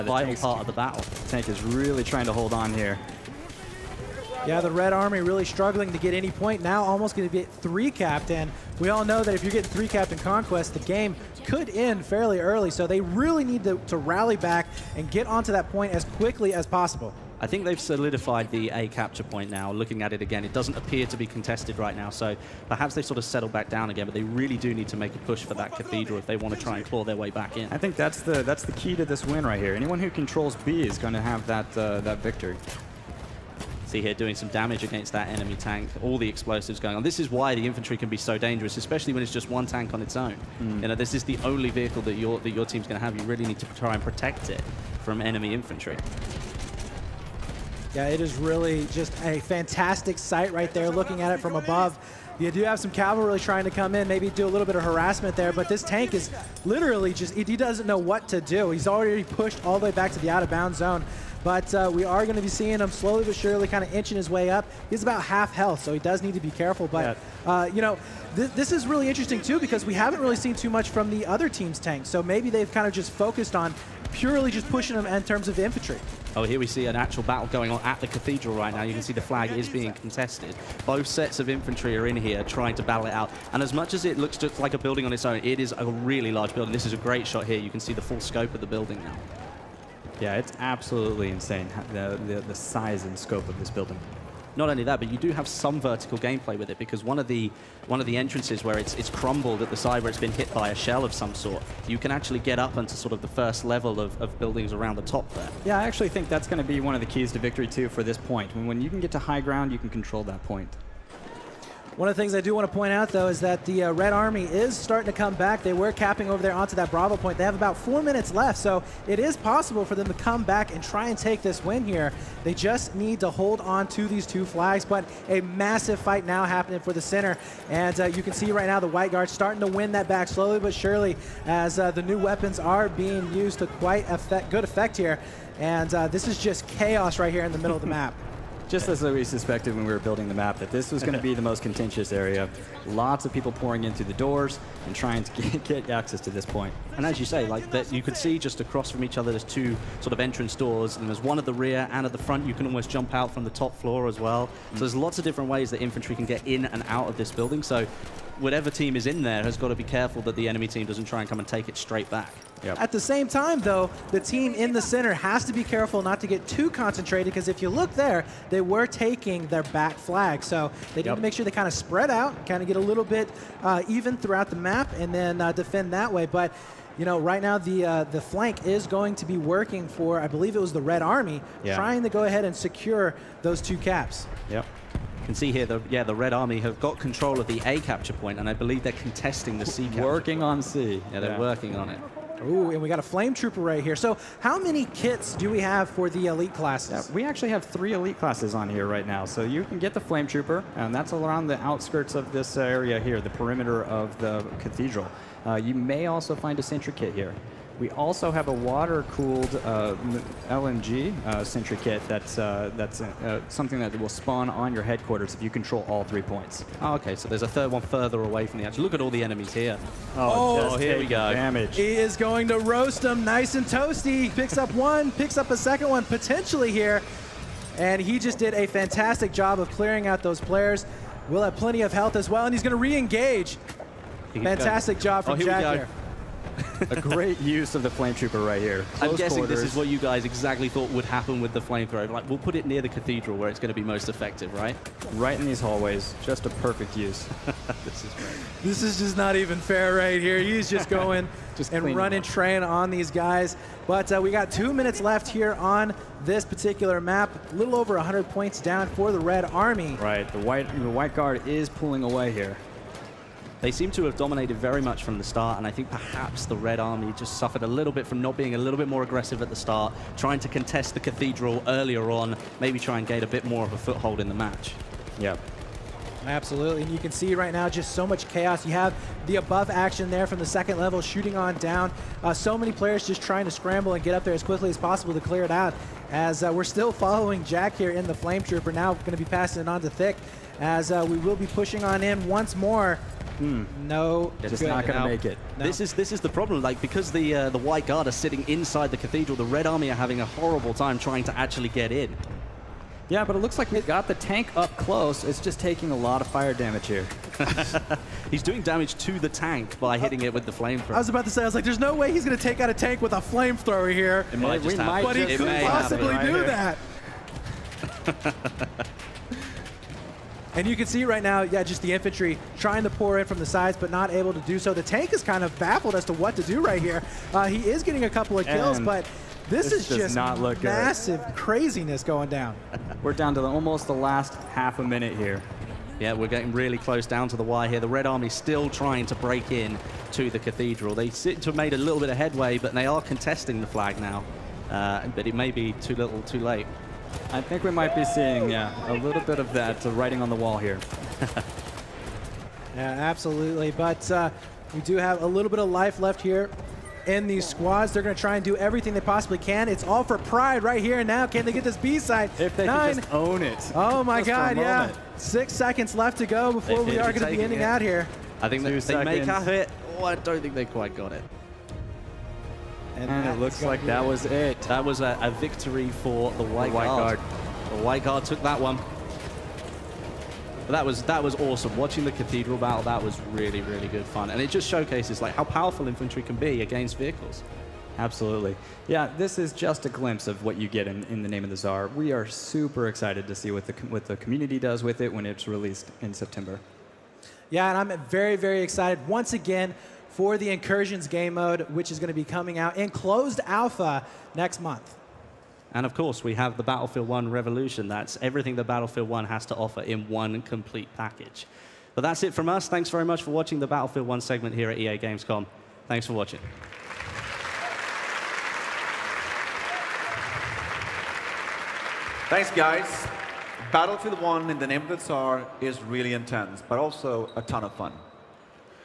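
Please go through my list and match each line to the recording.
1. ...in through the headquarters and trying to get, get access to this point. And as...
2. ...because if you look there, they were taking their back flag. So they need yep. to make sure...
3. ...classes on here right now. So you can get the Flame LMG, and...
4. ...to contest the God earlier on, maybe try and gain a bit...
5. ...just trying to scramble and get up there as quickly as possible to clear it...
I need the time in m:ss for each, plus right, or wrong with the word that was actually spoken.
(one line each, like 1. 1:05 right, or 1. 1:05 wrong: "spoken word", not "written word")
1. 2:23 wrong: "doors", not "headquarters"
2. 2:47 right
3. 3:18 wrong: "Trooper", not "LMG"
4. 4:30 wrong: "Cathedral", not "God"
5. 4:43 right.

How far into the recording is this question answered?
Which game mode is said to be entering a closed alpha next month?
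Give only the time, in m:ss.
6:40.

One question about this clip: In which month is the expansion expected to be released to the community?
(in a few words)
September.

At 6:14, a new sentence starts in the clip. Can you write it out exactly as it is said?
That was a, a victory for the White, the White Guard.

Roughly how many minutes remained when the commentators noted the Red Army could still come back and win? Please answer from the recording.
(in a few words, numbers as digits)
4 minutes.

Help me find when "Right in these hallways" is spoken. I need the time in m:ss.
4:05.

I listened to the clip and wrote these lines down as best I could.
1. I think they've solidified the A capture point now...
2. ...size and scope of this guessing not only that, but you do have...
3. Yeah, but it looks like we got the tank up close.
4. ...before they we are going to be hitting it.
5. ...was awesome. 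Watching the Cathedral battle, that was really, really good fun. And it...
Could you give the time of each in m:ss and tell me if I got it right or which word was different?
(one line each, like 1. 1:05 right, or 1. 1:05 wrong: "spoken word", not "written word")
1. 0:17 right
2. 1:32 wrong: "building", not "guessing"
3. 5:03 right
4. 6:06 wrong: "ending", not "hitting"
5. 6:21 right.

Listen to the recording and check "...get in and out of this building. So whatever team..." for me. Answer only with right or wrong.
right.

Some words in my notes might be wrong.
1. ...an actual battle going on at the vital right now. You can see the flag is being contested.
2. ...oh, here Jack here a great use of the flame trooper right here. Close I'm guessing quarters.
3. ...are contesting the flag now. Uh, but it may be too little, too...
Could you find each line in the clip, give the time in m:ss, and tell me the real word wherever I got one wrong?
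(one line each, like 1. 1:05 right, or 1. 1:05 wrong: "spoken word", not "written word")
1. 1:16 wrong: "cathedral", not "vital"
2. 3:55 right
3. 5:42 right.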